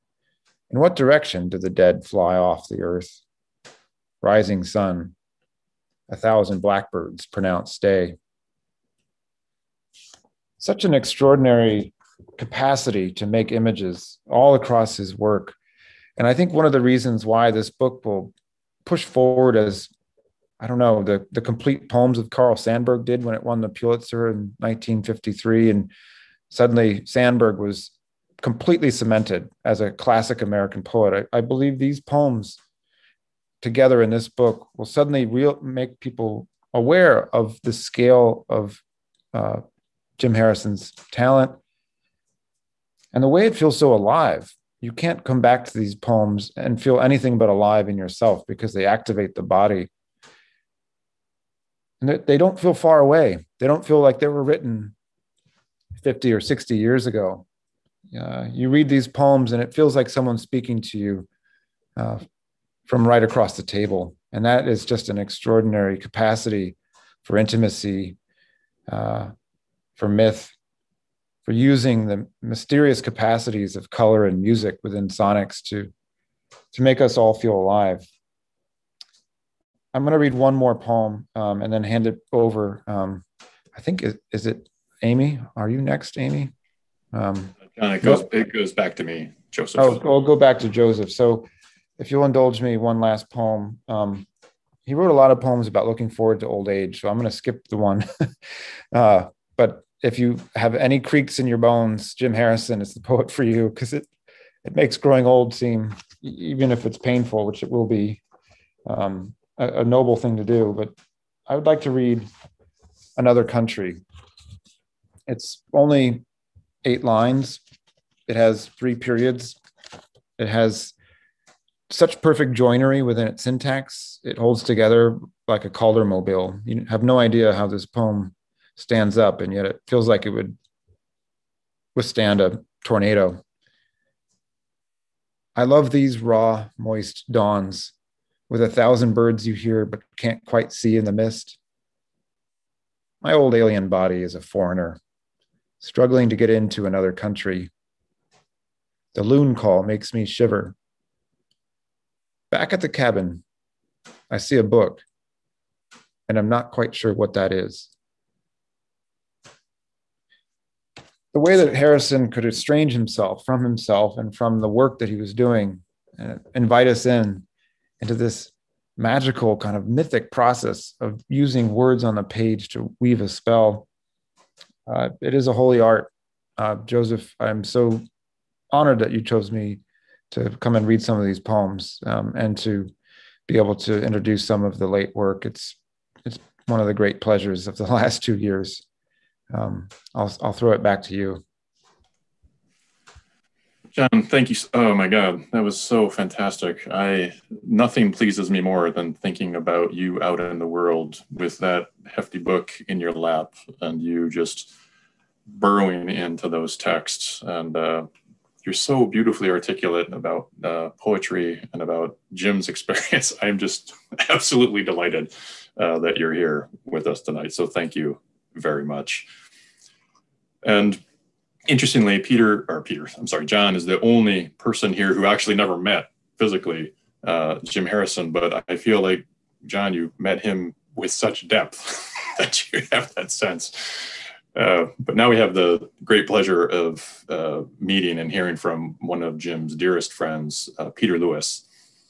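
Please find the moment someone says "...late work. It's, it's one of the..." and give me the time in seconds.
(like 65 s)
184 s.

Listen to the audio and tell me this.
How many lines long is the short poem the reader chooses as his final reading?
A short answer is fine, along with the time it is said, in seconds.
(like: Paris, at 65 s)
8, at 116 s.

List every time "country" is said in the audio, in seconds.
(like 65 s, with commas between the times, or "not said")
113 s, 147 s.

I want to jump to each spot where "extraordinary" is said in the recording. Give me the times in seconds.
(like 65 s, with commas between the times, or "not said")
10 s, 65 s.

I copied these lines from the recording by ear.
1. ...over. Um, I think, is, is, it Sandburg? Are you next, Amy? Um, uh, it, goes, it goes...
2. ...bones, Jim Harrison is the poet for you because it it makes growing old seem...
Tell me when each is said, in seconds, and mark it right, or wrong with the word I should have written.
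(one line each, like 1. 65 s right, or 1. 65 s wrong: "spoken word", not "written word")
1. 82 s wrong: "Amy", not "Sandburg"
2. 101 s right.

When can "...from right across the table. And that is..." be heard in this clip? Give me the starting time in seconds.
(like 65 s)
62 s.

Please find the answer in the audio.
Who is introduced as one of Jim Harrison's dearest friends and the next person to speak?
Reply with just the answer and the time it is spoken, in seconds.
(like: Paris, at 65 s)
Peter Lewis, at 240 s.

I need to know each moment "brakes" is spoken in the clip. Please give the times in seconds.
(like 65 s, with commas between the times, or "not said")
not said.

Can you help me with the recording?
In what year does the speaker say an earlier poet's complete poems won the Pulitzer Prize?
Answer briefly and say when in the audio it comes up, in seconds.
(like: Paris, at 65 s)
1953, at 24 s.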